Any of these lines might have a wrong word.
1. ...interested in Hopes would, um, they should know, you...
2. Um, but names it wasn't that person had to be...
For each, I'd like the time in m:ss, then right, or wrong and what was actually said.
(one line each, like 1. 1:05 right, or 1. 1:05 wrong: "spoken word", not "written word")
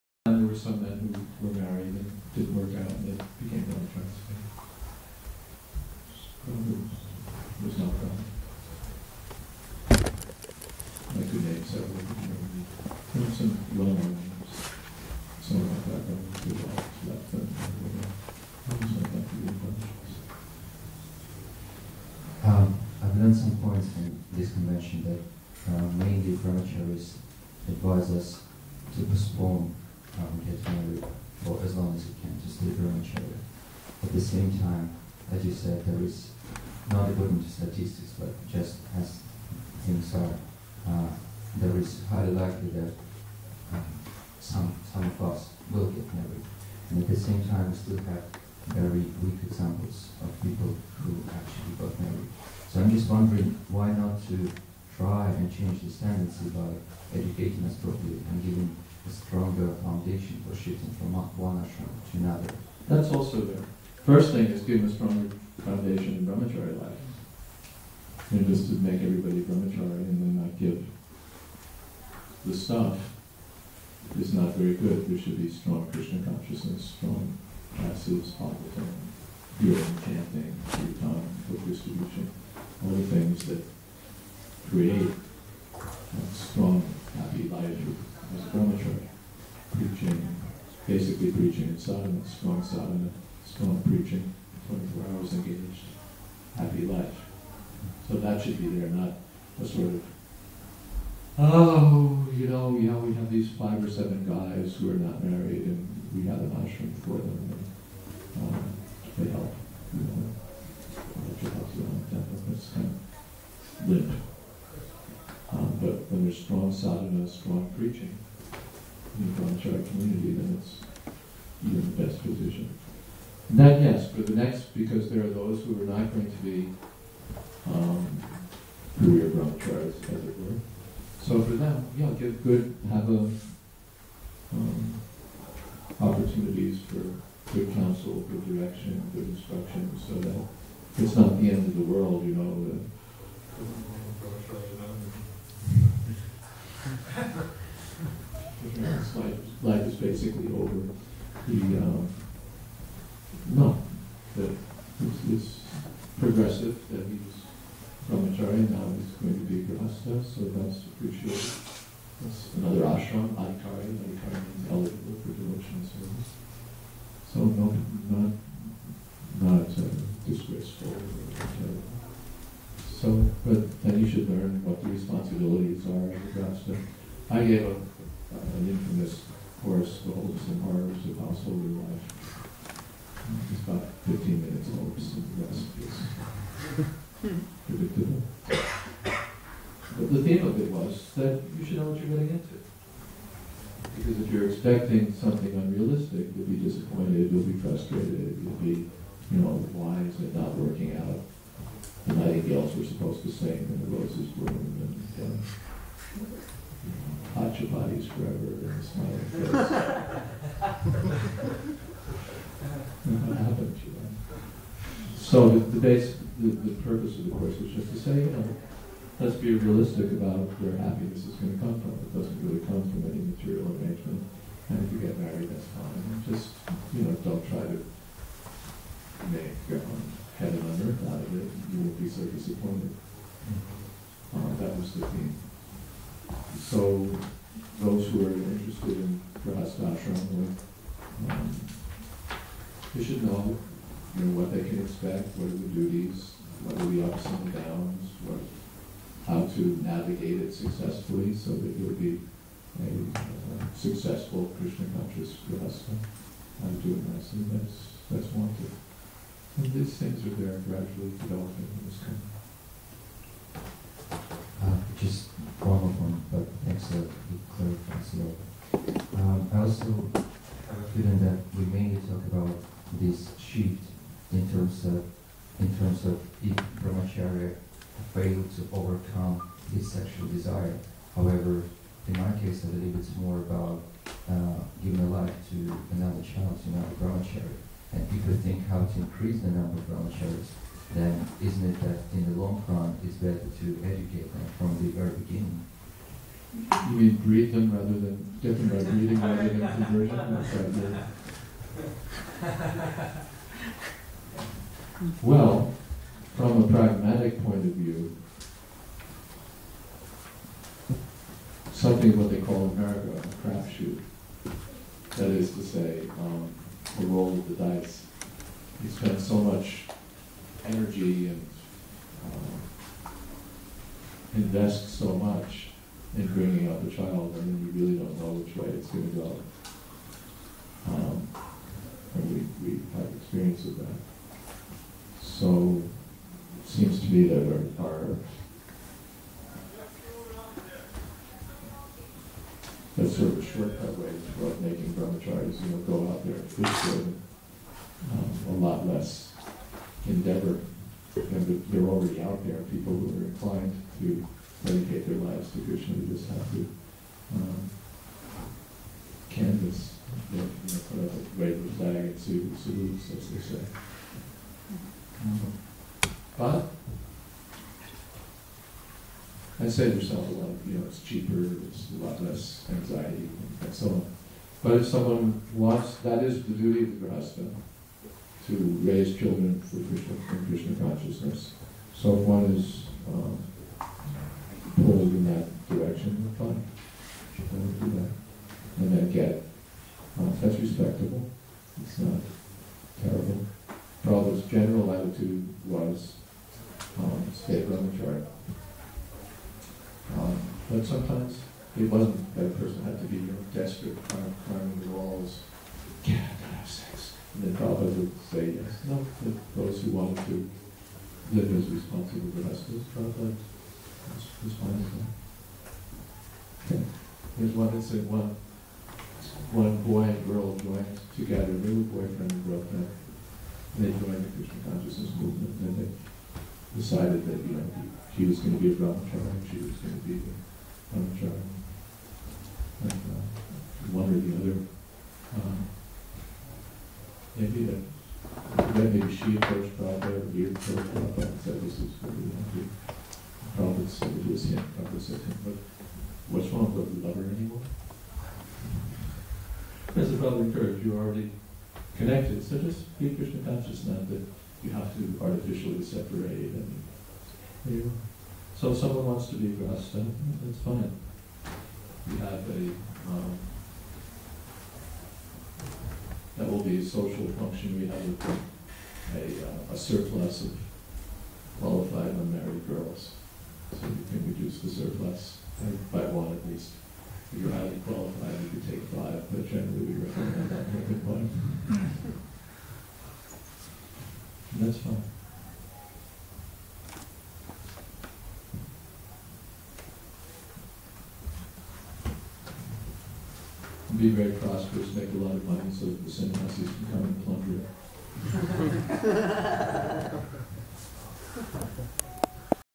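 1. 3:58 wrong: "Grihasthashram", not "Hopes"
2. 6:40 wrong: "sometimes", not "names".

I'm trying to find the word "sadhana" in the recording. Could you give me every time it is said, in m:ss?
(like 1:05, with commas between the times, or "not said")
1:32, 1:56.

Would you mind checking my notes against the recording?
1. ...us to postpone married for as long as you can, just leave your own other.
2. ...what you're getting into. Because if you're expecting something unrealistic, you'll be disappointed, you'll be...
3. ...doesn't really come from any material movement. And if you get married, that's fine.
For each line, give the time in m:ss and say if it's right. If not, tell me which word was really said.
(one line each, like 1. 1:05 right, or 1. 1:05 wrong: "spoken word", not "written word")
1. 0:28 right
2. 3:11 right
3. 3:42 wrong: "arrangement", not "movement".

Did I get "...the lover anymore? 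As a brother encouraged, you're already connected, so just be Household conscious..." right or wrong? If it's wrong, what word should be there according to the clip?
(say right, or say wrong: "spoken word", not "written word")
wrong: "Krishna", not "Household".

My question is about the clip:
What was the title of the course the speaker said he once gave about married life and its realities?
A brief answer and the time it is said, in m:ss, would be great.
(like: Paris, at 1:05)
The Hopes and Horrors of Household Life, at 3:00.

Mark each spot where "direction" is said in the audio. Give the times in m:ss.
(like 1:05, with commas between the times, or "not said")
2:18, 6:25.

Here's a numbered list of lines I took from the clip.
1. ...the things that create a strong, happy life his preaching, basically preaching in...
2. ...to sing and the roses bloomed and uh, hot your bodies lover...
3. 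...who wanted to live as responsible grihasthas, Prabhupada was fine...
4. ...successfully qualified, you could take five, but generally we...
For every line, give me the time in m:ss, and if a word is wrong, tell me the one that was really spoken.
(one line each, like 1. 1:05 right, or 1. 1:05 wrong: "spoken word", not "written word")
1. 1:22 right
2. 3:23 wrong: "forever", not "lover"
3. 6:49 right
4. 7:57 wrong: "highly", not "successfully".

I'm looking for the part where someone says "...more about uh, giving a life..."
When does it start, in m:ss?
4:43.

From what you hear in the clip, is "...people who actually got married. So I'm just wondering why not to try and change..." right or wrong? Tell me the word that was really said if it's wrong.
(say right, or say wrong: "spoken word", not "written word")
right.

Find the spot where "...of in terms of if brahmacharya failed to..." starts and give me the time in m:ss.
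4:34.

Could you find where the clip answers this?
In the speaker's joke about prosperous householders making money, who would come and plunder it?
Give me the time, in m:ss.
8:16.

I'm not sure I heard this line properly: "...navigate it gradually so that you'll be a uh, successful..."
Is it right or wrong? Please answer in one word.
wrong.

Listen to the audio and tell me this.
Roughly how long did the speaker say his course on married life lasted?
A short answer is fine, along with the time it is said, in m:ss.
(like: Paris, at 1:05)
15 minutes, at 3:04.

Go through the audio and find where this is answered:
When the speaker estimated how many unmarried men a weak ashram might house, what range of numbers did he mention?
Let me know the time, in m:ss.
1:43.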